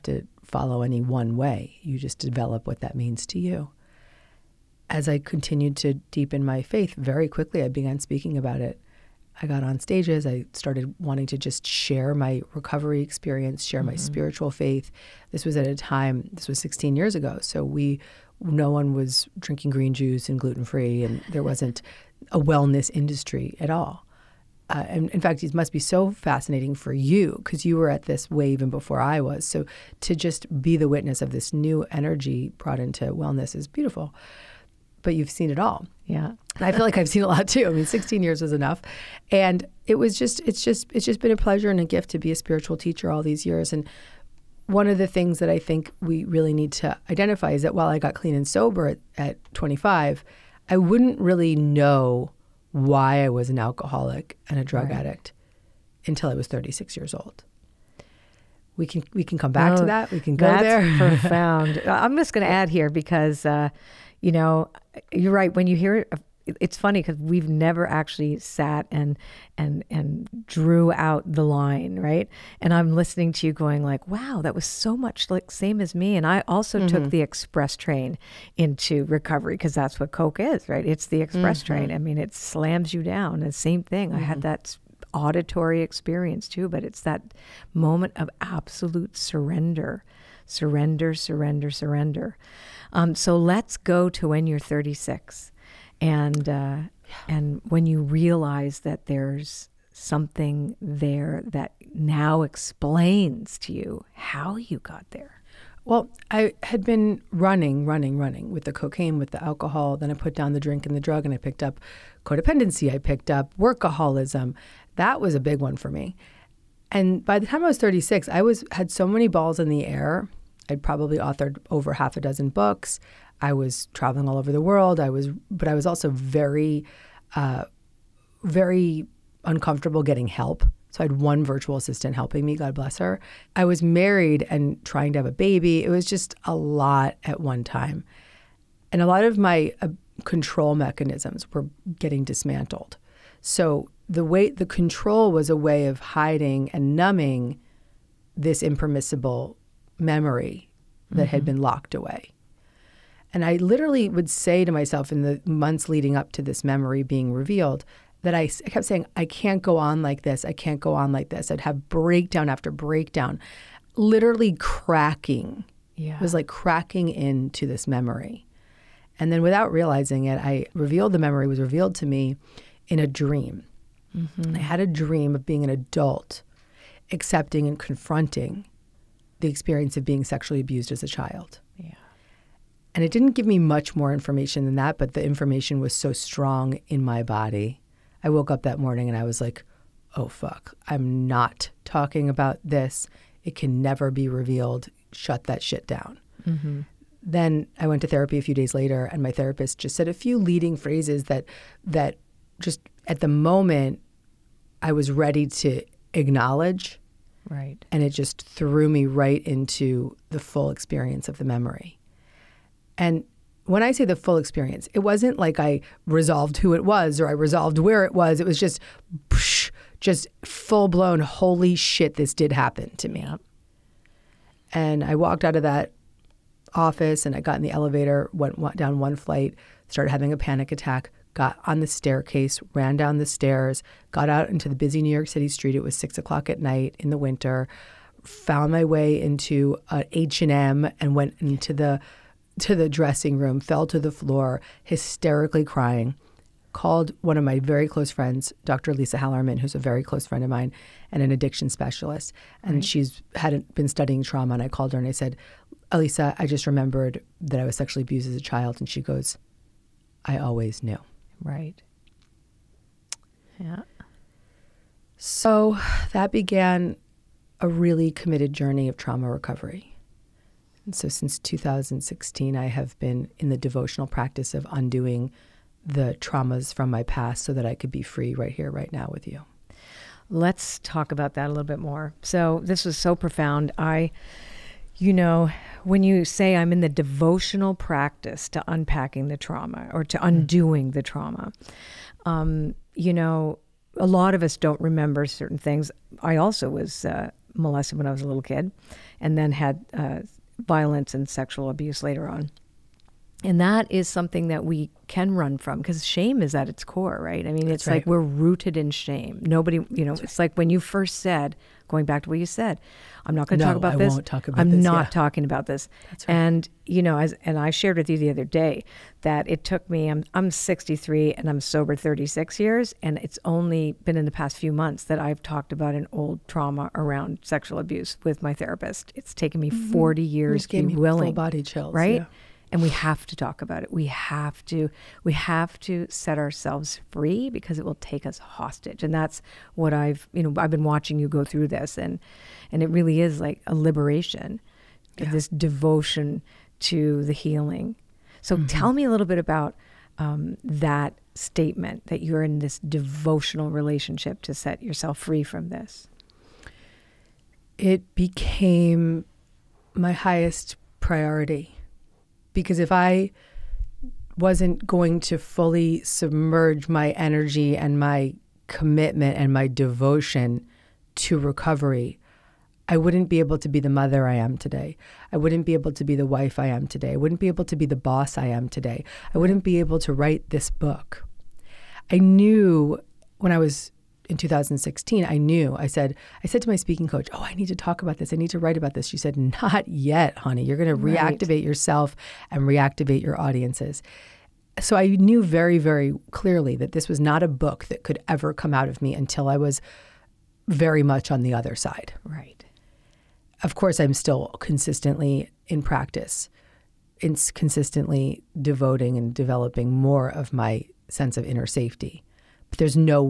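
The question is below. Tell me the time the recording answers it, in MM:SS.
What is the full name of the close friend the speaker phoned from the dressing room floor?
04:08.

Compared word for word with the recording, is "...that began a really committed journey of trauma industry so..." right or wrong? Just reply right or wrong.
wrong.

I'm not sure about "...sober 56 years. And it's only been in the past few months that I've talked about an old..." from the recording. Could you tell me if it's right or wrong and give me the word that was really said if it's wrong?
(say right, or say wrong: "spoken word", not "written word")
wrong: "36", not "56".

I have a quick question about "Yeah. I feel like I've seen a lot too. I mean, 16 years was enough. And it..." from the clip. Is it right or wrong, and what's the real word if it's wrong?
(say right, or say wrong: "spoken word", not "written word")
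right.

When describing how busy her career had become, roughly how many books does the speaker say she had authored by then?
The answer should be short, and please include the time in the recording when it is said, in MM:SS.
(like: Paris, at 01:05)
over half a dozen, at 02:01.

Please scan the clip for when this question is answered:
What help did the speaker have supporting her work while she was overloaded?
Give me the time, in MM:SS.
02:11.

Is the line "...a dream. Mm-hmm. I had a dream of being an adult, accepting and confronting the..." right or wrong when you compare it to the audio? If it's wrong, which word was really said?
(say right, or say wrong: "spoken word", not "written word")
right.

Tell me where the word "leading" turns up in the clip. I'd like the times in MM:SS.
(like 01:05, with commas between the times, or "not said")
02:35, 03:20.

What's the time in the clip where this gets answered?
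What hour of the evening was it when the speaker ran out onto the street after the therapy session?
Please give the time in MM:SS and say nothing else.
03:55.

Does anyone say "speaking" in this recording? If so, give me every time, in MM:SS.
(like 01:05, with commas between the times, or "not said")
00:07, 06:26.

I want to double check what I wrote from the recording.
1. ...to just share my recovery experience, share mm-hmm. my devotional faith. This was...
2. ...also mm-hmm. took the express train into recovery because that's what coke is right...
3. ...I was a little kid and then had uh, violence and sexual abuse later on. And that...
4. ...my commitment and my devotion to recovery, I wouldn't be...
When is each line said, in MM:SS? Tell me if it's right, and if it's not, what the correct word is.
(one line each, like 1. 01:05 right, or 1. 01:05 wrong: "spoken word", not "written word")
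1. 00:11 wrong: "spiritual", not "devotional"
2. 01:16 right
3. 04:58 right
4. 06:08 right.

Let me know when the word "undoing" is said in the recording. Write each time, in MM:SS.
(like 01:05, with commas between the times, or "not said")
04:34, 04:50.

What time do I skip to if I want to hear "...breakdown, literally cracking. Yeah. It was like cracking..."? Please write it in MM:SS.
02:42.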